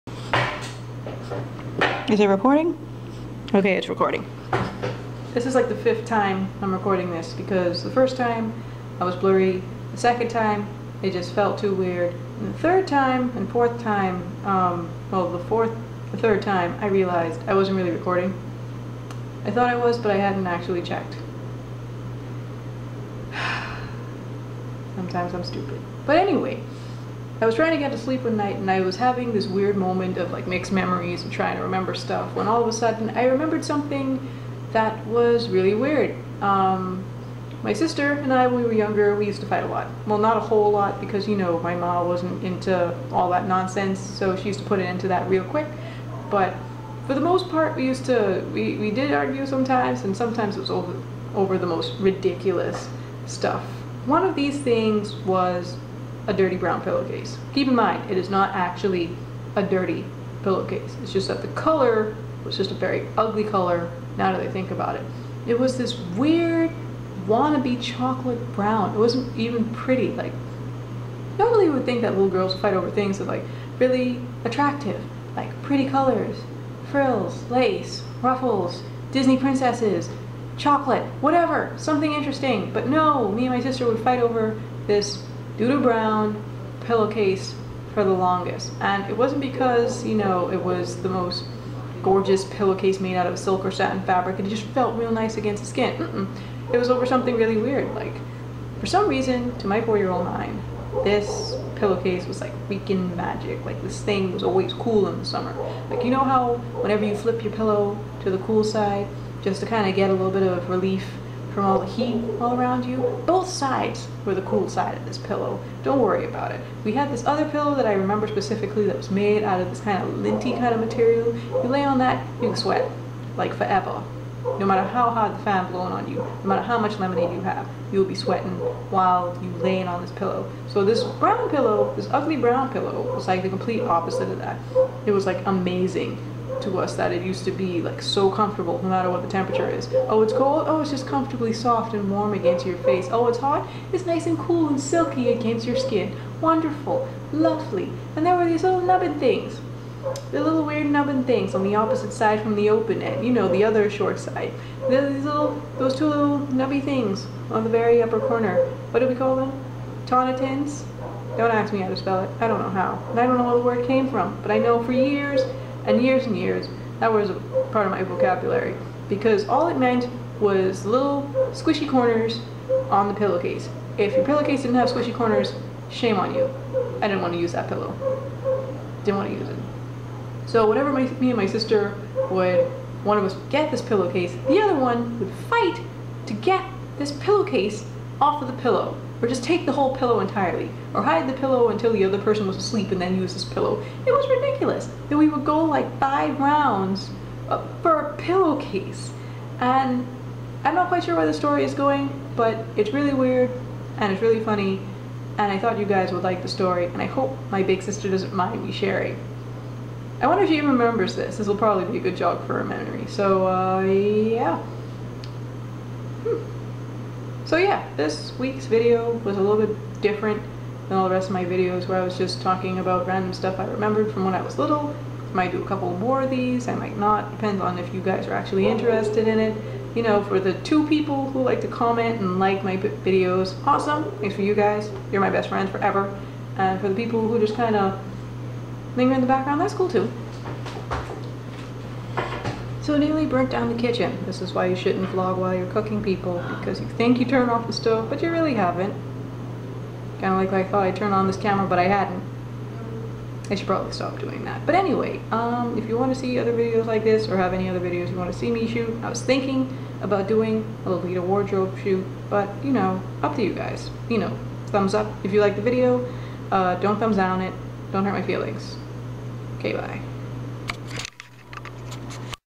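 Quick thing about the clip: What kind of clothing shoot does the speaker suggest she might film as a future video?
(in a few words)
Lolita wardrobe shoot.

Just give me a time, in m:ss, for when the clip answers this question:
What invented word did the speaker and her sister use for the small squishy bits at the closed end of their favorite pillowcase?
2:40.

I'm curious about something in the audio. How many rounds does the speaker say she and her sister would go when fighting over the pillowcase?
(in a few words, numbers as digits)
5.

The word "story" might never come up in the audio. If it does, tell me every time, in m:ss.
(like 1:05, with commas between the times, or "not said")
3:21, 3:26.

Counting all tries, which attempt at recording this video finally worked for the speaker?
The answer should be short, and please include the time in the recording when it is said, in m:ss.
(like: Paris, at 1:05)
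fifth, at 0:05.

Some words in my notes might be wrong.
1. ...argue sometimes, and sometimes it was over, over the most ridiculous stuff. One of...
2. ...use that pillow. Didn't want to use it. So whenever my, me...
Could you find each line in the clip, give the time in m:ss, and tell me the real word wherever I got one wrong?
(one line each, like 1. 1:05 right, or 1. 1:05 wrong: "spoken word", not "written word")
1. 0:49 right
2. 2:57 right.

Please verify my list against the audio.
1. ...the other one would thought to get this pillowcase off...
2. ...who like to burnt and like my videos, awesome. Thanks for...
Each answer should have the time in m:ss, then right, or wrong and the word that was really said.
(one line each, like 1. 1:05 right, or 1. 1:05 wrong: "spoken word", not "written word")
1. 3:04 wrong: "fight", not "thought"
2. 3:51 wrong: "comment", not "burnt".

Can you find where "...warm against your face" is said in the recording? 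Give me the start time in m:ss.
2:22.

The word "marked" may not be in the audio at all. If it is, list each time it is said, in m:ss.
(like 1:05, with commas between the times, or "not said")
not said.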